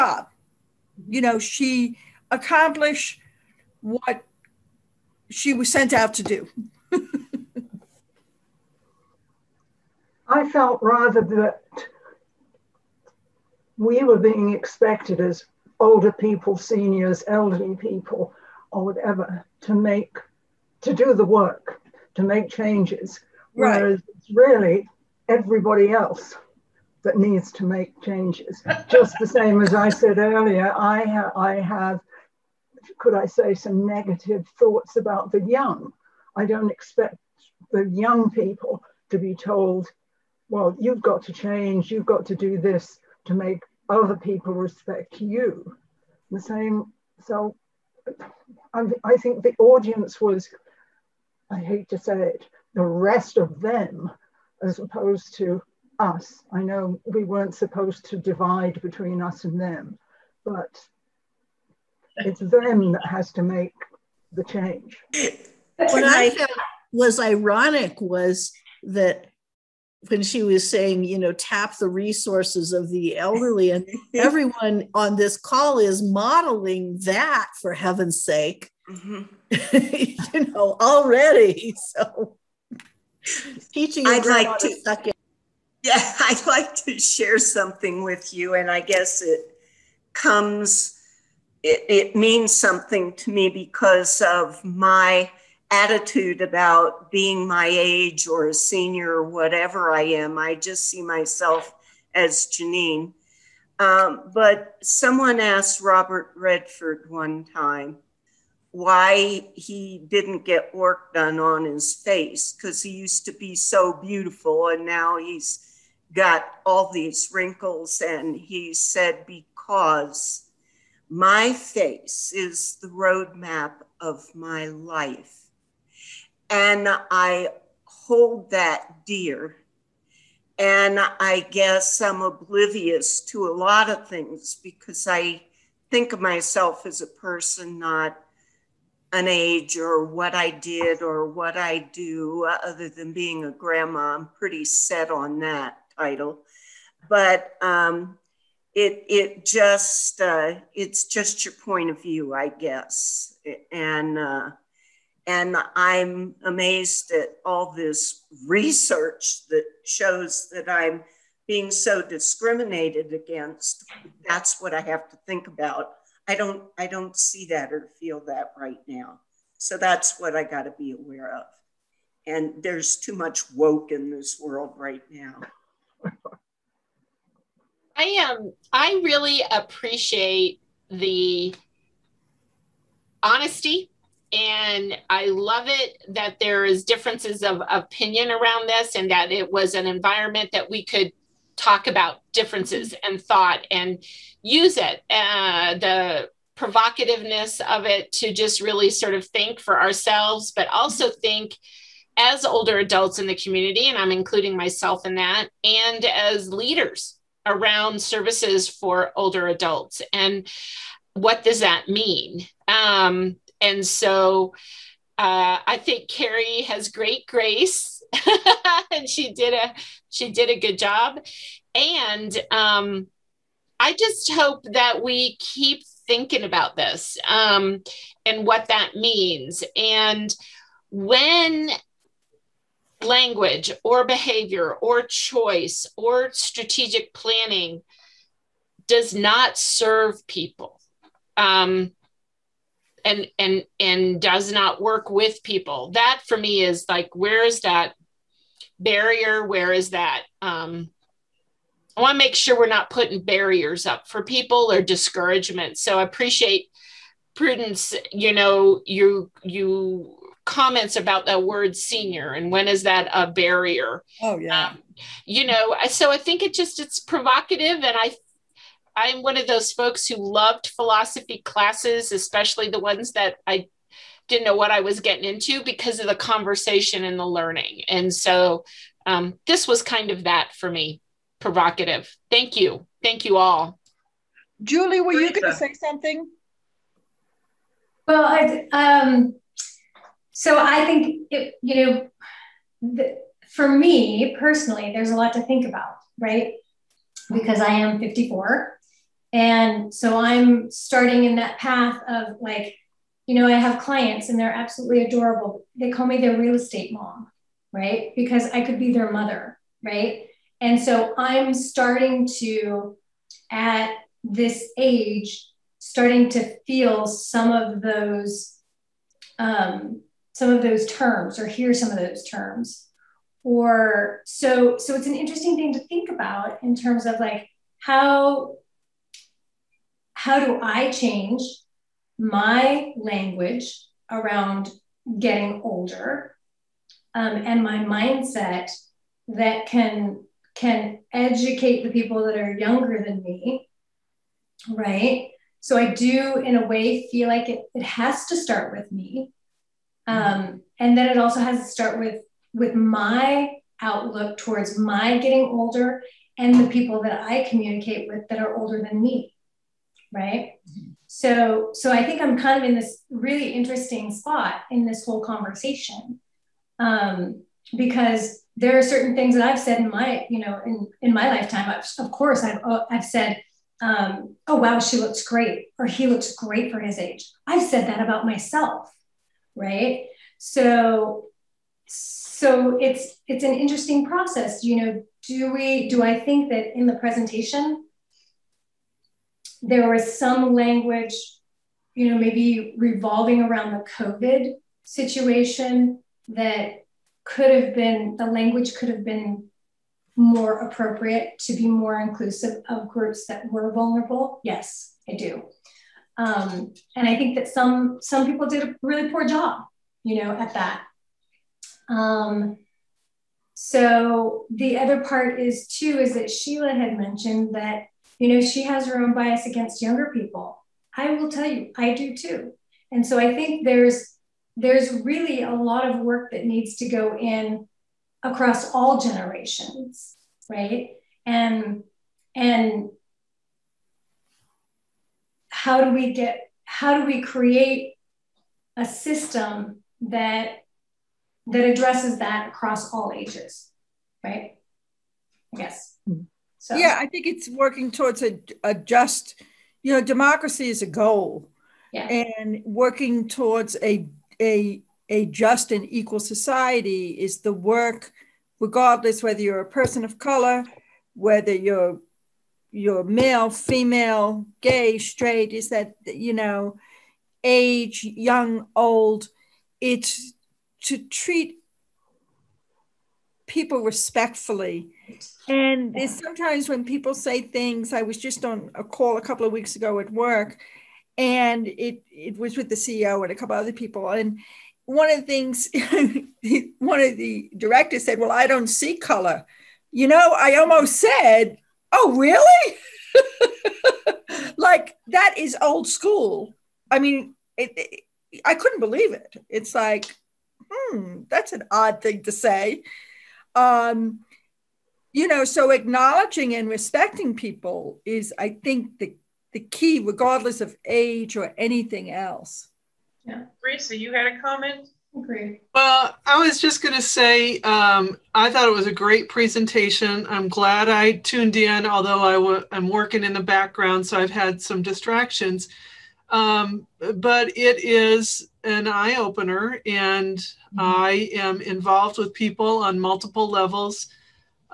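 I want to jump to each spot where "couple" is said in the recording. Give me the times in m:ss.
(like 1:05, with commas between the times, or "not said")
7:59, 8:03.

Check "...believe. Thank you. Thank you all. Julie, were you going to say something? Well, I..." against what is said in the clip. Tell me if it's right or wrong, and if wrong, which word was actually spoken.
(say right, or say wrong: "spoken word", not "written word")
wrong: "provocative", not "believe".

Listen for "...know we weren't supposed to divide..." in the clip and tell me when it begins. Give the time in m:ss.
0:56.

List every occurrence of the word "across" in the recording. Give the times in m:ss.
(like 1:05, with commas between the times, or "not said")
7:08, 7:22.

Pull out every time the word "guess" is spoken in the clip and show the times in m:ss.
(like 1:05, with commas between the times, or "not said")
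1:28, 2:11, 2:32.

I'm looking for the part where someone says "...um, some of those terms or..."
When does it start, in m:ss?
5:19.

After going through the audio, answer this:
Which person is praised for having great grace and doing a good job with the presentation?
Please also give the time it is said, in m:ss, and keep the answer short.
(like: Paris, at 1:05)
Carrie, at 3:36.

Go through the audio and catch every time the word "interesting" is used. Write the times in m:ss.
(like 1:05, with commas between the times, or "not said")
5:25, 6:03, 6:23.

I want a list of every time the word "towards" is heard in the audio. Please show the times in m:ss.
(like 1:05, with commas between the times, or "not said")
5:54, 7:27, 7:33.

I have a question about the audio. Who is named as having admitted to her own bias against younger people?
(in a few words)
Sheila.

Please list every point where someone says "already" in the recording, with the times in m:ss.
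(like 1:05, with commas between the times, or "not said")
1:20.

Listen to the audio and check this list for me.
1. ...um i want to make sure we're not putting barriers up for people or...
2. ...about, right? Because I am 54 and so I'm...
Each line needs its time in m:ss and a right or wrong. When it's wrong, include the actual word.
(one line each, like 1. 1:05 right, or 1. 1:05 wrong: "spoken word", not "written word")
1. 4:10 right
2. 4:55 right.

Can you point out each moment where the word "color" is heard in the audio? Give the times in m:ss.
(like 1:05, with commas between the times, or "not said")
7:40, 8:08.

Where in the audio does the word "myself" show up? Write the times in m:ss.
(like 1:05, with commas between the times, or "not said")
1:41, 2:16, 3:24, 6:18.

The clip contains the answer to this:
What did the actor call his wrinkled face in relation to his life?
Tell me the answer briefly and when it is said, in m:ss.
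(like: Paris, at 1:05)
the roadmap, at 2:02.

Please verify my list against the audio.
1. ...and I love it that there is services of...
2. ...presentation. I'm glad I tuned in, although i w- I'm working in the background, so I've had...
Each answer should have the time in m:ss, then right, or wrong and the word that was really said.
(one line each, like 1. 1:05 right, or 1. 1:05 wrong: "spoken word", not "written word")
1. 3:04 wrong: "differences", not "services"
2. 8:39 right.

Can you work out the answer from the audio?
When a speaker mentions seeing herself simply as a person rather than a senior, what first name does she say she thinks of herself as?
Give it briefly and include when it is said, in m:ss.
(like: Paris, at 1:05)
Janine, at 1:42.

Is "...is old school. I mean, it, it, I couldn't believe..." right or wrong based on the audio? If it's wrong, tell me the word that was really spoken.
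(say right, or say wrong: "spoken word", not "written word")
right.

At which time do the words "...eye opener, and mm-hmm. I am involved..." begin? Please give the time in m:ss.
8:48.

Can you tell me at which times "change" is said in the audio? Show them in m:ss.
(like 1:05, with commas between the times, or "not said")
0:22, 0:28, 0:41, 1:04, 5:30.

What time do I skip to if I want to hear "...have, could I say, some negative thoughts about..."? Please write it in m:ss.
0:31.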